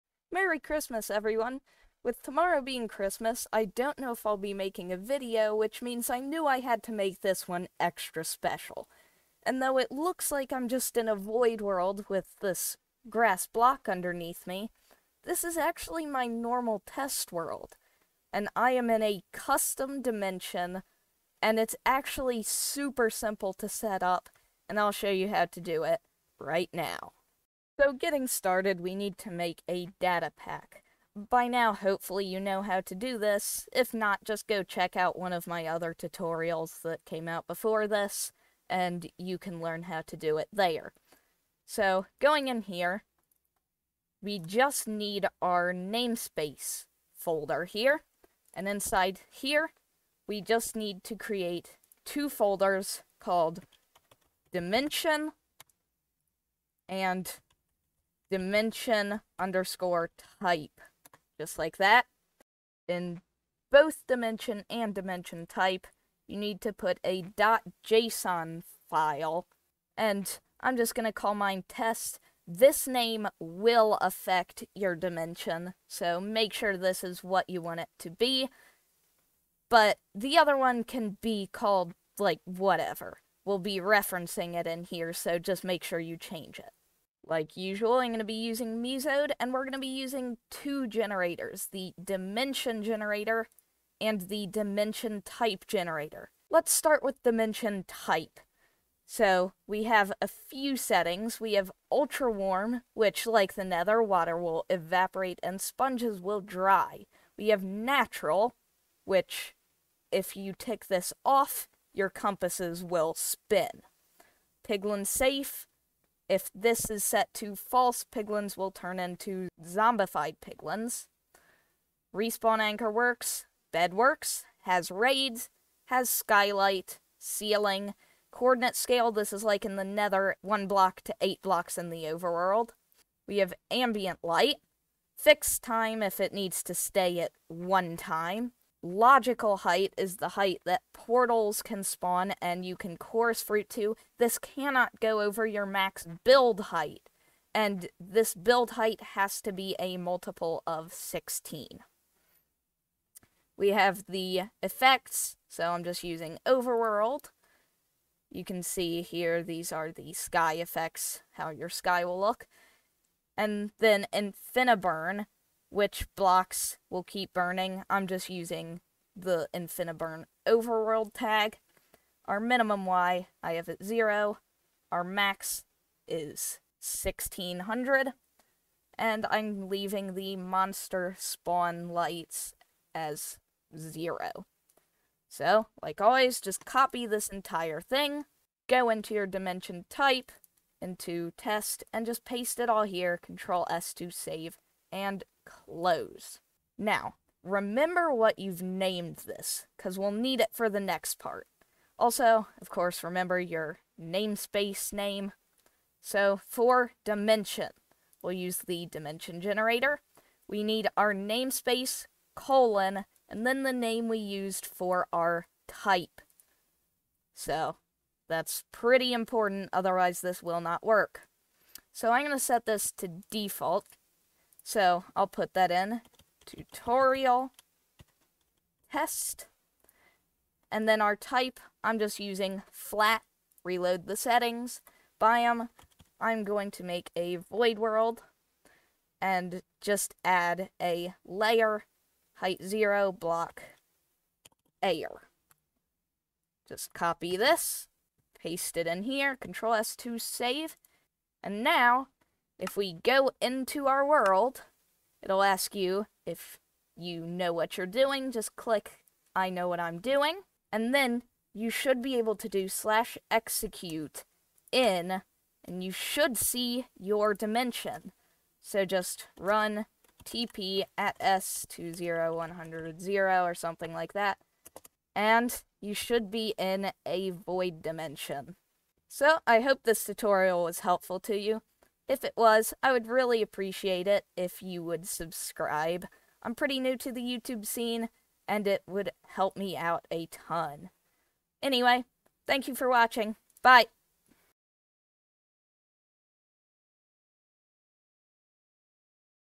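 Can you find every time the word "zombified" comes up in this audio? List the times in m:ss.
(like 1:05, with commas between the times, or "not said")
1:59.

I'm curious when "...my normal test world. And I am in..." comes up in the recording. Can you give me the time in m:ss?
0:16.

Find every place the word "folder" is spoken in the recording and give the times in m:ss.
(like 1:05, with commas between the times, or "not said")
0:47, 0:52.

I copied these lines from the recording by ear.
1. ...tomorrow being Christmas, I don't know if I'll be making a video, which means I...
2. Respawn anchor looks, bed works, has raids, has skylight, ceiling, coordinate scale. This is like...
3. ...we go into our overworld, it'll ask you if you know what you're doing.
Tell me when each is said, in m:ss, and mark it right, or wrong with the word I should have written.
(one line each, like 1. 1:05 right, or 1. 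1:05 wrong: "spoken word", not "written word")
1. 0:02 right
2. 2:02 wrong: "works", not "looks"
3. 4:12 wrong: "world", not "overworld".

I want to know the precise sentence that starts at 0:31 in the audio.
By now, hopefully you know how to do this.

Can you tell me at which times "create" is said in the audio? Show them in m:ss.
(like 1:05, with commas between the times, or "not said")
0:51.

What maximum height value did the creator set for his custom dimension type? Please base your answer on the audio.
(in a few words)
1600.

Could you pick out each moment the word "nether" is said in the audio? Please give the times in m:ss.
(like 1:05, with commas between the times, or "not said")
1:43, 2:09.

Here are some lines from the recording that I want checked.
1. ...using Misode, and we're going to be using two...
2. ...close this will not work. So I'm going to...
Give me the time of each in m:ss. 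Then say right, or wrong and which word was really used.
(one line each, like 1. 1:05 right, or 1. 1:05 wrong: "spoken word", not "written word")
1. 1:28 right
2. 3:39 wrong: "otherwise", not "close".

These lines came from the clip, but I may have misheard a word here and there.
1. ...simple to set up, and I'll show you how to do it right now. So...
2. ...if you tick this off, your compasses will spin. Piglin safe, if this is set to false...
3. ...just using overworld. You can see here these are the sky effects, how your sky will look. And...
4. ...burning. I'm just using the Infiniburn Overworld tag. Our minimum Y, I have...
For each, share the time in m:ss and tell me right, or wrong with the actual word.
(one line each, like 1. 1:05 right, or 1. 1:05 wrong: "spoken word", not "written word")
1. 0:23 right
2. 1:50 right
3. 2:35 right
4. 2:47 right.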